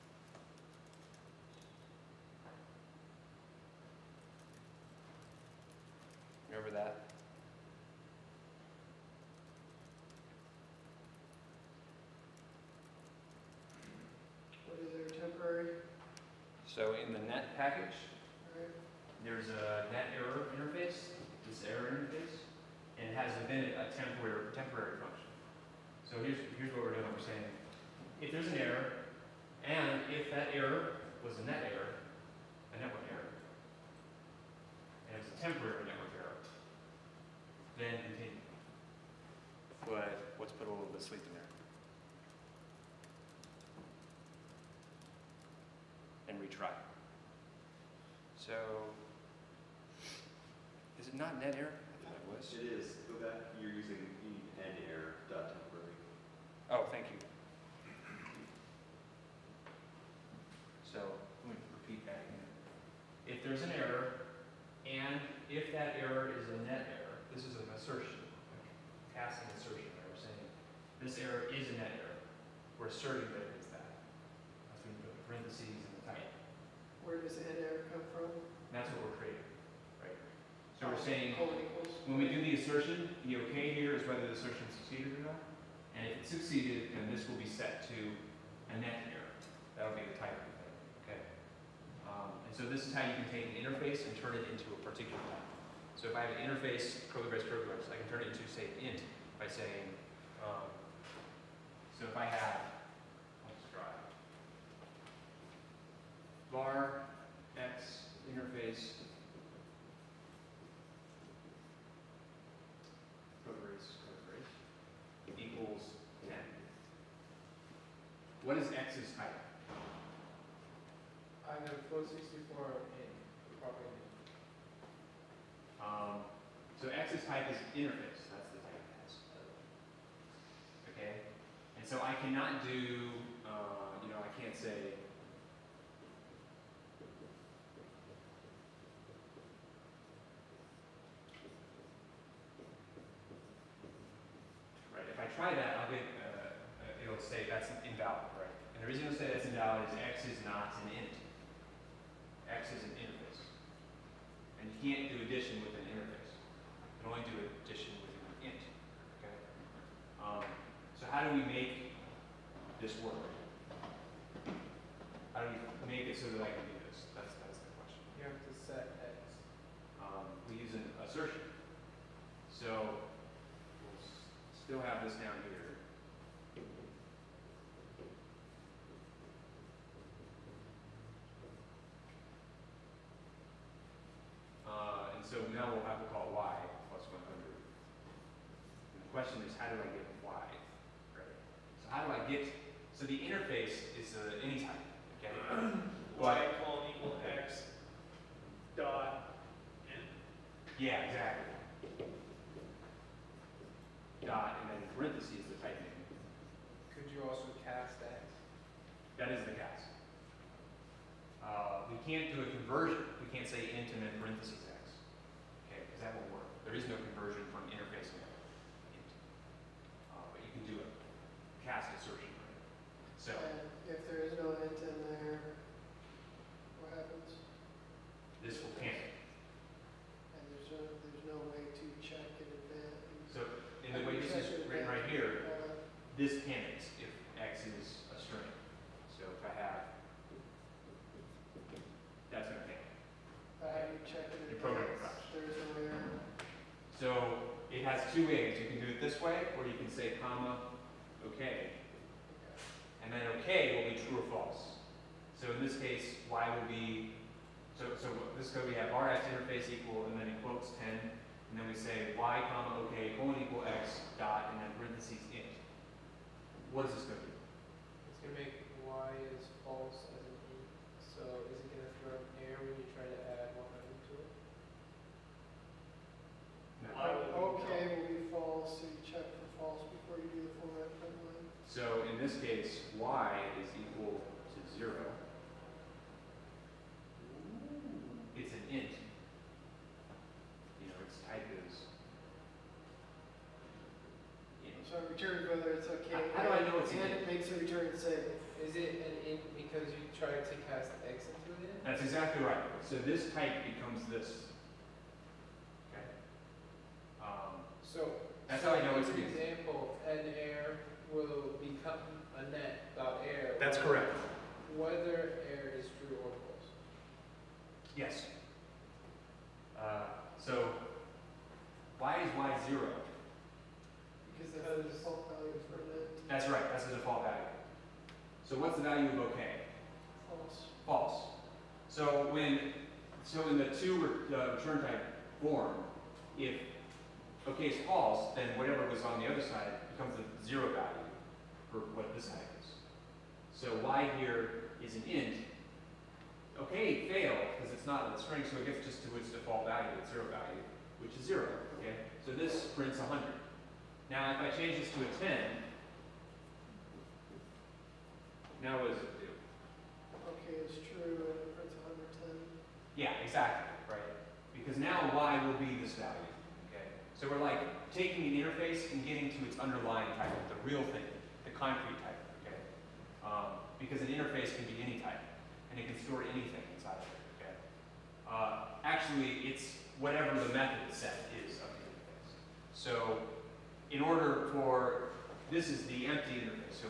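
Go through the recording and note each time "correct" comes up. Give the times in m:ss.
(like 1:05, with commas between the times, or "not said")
5:13.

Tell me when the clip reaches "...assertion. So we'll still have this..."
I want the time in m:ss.
2:51.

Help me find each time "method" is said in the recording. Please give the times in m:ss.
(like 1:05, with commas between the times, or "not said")
6:20.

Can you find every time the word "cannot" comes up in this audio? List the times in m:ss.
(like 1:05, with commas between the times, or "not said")
2:12.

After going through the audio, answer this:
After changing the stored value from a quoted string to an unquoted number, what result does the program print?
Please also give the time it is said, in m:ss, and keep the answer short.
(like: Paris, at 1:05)
110, at 6:01.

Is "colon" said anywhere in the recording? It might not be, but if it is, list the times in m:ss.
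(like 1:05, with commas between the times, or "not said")
4:23.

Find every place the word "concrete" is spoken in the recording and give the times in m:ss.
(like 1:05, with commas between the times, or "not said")
6:11.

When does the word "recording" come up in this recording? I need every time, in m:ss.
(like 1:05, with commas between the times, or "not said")
not said.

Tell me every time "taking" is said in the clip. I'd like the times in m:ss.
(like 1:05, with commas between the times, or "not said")
6:07.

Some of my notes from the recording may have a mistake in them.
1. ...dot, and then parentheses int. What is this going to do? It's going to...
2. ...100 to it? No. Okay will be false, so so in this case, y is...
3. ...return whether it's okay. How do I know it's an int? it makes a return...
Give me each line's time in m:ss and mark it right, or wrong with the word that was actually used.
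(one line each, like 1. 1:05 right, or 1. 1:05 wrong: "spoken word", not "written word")
1. 4:24 right
2. 4:33 right
3. 4:55 right.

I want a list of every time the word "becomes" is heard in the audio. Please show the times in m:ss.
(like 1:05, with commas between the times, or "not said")
5:03, 5:11, 5:39.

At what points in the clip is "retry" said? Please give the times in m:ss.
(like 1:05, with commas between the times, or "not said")
0:46.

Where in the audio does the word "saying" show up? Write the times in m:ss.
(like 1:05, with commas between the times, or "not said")
0:27, 1:10, 1:21, 1:39.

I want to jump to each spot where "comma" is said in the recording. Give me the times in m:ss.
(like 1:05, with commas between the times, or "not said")
4:10, 4:22.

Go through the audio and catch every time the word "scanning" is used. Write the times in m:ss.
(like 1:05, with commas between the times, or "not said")
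not said.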